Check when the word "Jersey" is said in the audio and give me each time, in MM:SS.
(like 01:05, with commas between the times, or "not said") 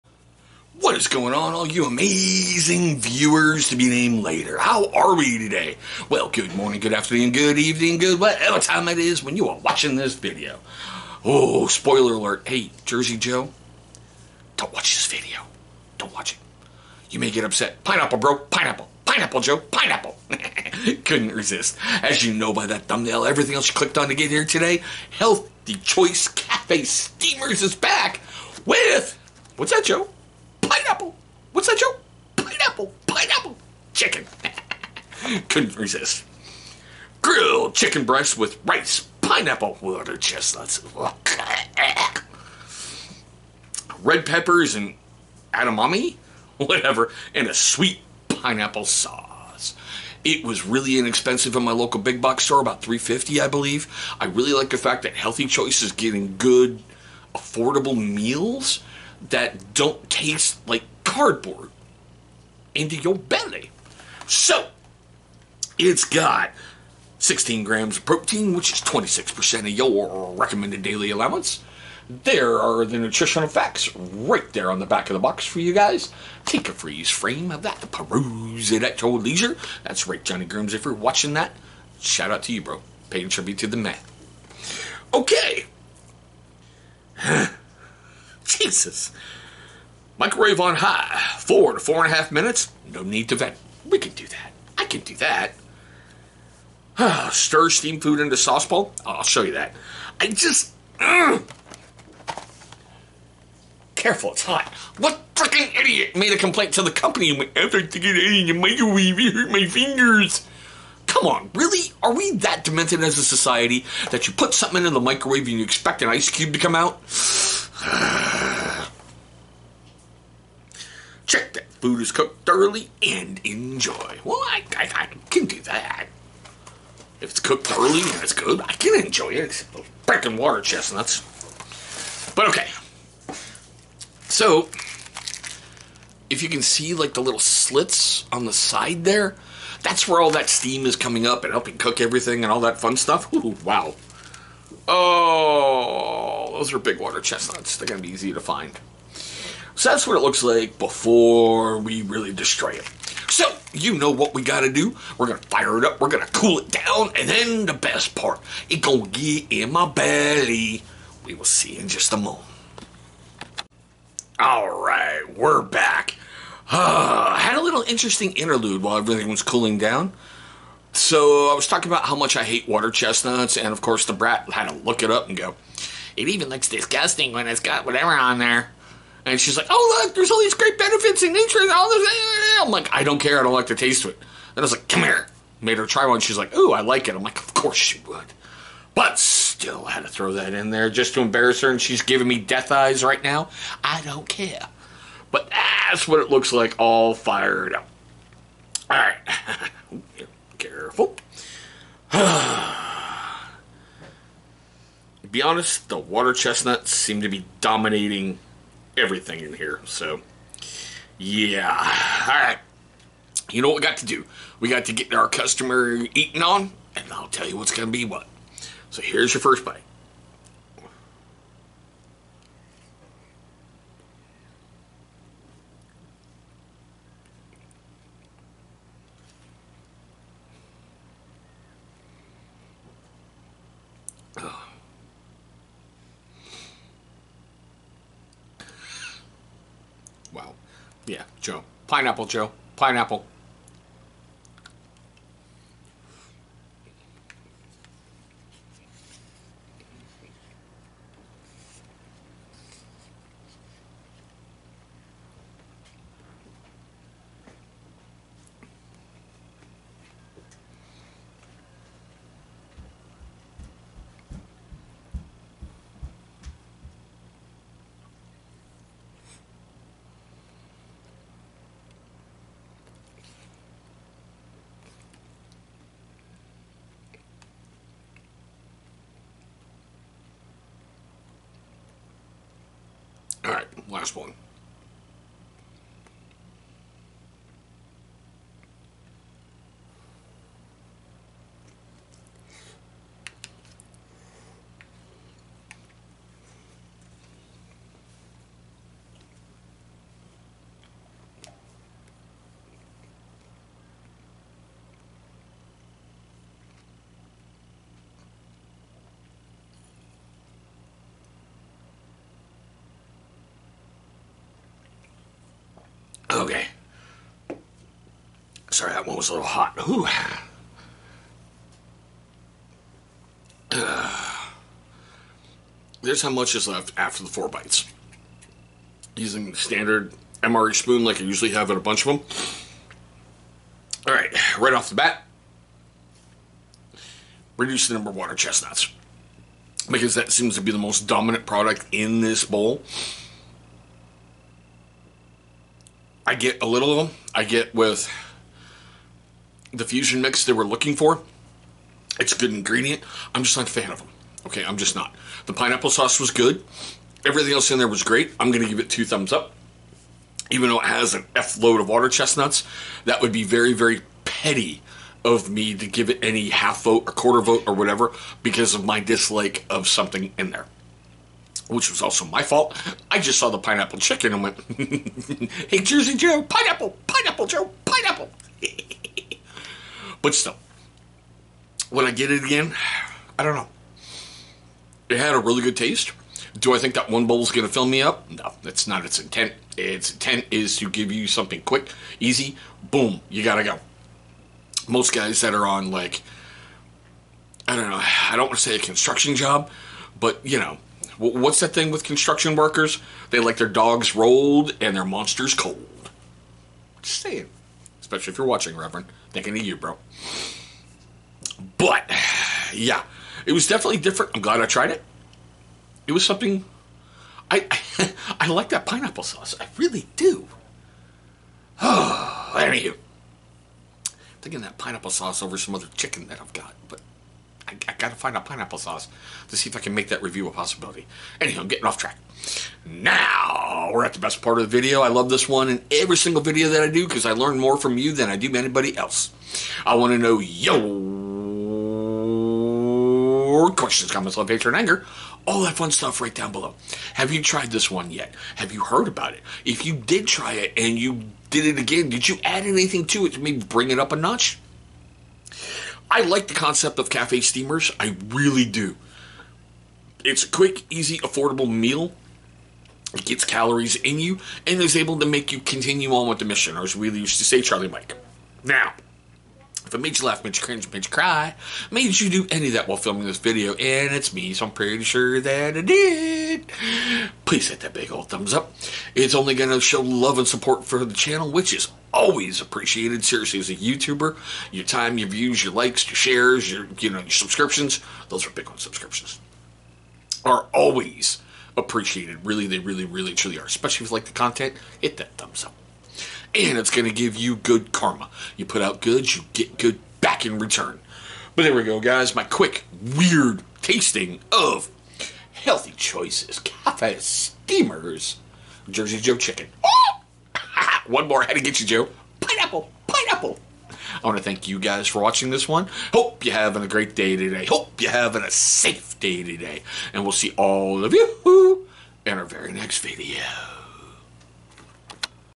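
00:12, 06:15, 08:28.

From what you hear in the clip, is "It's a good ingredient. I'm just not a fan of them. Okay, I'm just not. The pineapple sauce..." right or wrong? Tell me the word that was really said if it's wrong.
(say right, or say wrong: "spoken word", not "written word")
right.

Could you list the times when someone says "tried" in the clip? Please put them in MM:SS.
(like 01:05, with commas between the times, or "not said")
06:54, 07:27.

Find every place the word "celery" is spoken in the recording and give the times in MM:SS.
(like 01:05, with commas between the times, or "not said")
not said.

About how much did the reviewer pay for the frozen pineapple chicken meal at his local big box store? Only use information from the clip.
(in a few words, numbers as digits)
$3.50.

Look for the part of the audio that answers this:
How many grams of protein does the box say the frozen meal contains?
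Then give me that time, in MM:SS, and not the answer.
01:07.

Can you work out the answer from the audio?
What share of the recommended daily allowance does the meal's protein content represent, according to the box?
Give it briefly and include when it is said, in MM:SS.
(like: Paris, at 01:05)
26%, at 01:08.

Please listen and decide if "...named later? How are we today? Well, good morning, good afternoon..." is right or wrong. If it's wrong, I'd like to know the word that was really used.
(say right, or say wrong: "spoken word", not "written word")
right.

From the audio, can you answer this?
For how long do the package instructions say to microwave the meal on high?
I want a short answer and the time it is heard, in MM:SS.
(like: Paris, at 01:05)
4 to 4.5 minutes, at 01:31.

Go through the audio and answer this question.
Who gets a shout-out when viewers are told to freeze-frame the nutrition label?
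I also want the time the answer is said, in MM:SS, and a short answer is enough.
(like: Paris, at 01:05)
Johnny Grooms, at 01:20.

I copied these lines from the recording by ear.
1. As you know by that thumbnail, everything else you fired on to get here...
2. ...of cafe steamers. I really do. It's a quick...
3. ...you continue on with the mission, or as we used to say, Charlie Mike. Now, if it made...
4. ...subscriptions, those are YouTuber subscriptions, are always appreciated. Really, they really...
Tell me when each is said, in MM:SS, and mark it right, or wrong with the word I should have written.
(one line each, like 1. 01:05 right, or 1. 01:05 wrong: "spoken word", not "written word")
1. 00:22 wrong: "clicked", not "fired"
2. 07:36 right
3. 07:45 right
4. 08:07 wrong: "Bitcoin", not "YouTuber".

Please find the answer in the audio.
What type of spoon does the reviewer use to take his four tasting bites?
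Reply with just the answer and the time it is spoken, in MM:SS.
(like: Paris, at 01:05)
MRE spoon, at 05:30.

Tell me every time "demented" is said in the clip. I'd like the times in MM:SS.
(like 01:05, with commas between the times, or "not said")
01:52.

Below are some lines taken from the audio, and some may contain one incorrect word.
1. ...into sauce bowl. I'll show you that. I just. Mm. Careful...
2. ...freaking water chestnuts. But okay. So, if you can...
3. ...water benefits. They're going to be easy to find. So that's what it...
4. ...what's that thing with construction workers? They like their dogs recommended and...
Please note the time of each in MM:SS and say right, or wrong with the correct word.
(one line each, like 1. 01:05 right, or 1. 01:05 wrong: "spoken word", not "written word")
1. 01:38 right
2. 02:10 right
3. 02:26 wrong: "chestnuts", not "benefits"
4. 06:41 wrong: "rolled", not "recommended".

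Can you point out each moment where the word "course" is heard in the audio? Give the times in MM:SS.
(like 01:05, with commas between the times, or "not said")
02:53, 03:07.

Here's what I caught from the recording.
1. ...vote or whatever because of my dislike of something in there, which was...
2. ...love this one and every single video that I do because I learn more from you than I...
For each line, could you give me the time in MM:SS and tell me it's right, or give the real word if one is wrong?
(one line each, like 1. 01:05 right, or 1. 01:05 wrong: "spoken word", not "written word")
1. 06:07 right
2. 07:15 right.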